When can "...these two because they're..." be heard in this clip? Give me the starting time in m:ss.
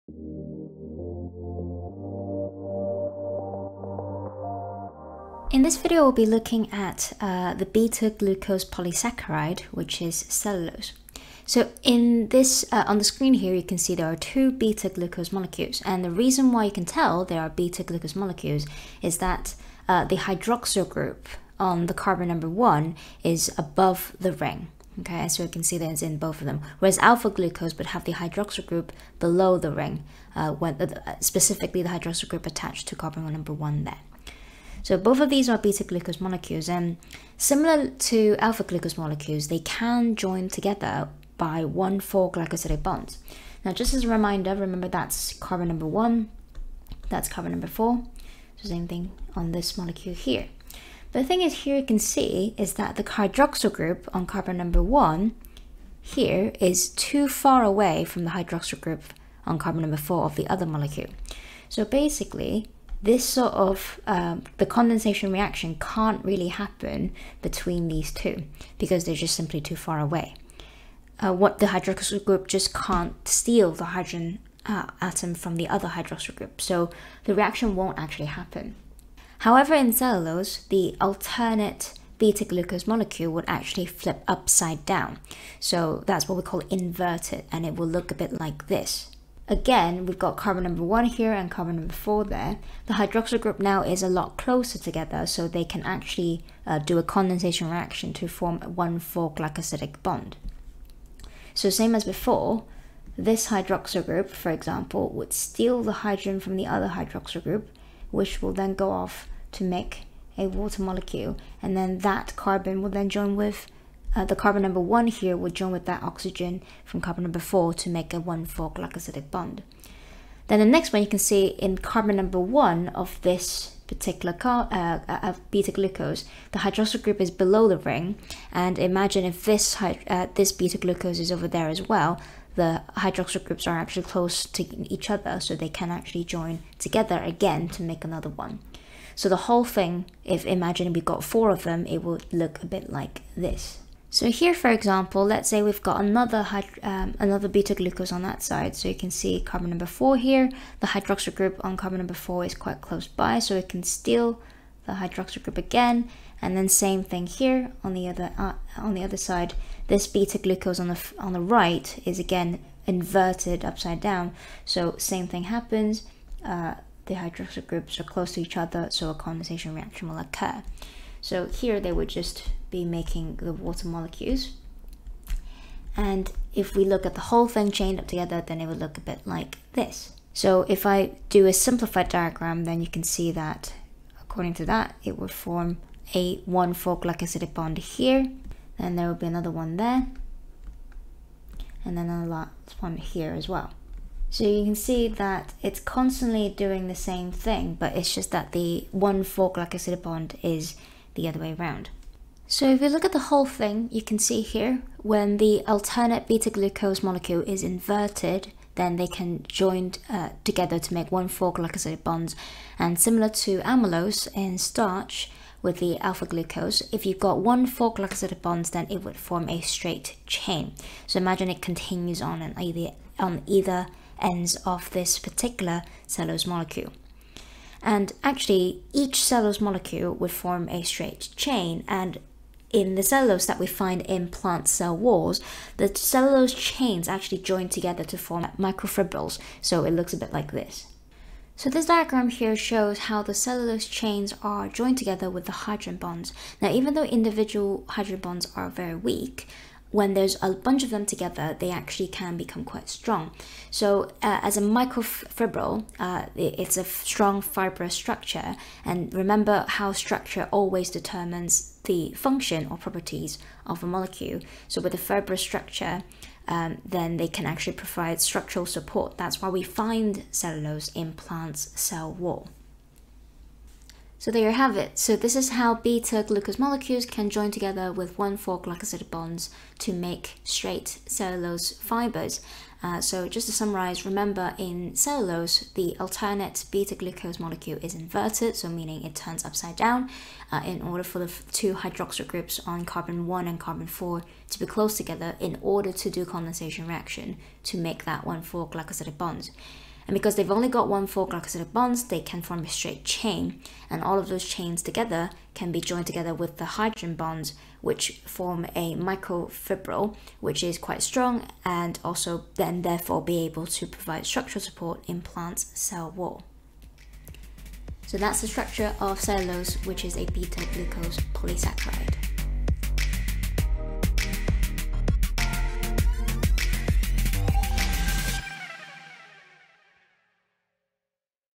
1:07.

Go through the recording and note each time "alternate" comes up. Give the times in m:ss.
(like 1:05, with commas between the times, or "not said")
1:21, 3:25, 4:45.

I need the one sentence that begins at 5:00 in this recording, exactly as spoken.
And because they've only got one 4 glycosidic bonds, they can form a straight chain.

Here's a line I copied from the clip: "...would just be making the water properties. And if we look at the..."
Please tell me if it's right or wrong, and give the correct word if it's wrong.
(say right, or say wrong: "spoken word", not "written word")
wrong: "molecules", not "properties".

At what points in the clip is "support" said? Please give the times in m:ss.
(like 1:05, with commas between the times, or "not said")
4:28, 5:14.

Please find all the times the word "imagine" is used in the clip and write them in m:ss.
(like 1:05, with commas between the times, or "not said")
2:08, 2:20, 3:41.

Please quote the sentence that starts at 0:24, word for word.
Okay, as you can see, there's in both of them.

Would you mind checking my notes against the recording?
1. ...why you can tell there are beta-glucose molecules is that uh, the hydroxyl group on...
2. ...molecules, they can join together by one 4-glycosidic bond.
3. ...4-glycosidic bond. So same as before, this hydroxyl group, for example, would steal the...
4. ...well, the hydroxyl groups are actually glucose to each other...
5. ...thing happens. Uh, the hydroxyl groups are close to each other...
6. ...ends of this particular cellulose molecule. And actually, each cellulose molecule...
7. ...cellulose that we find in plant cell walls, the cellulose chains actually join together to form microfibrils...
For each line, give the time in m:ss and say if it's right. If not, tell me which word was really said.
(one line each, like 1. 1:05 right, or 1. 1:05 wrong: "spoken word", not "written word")
1. 0:16 right
2. 0:38 right
3. 1:38 right
4. 2:11 wrong: "close", not "glucose"
5. 2:45 right
6. 3:44 right
7. 3:53 right.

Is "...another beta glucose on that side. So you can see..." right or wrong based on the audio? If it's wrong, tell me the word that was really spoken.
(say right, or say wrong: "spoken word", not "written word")
right.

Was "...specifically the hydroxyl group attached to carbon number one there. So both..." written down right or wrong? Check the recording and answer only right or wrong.
right.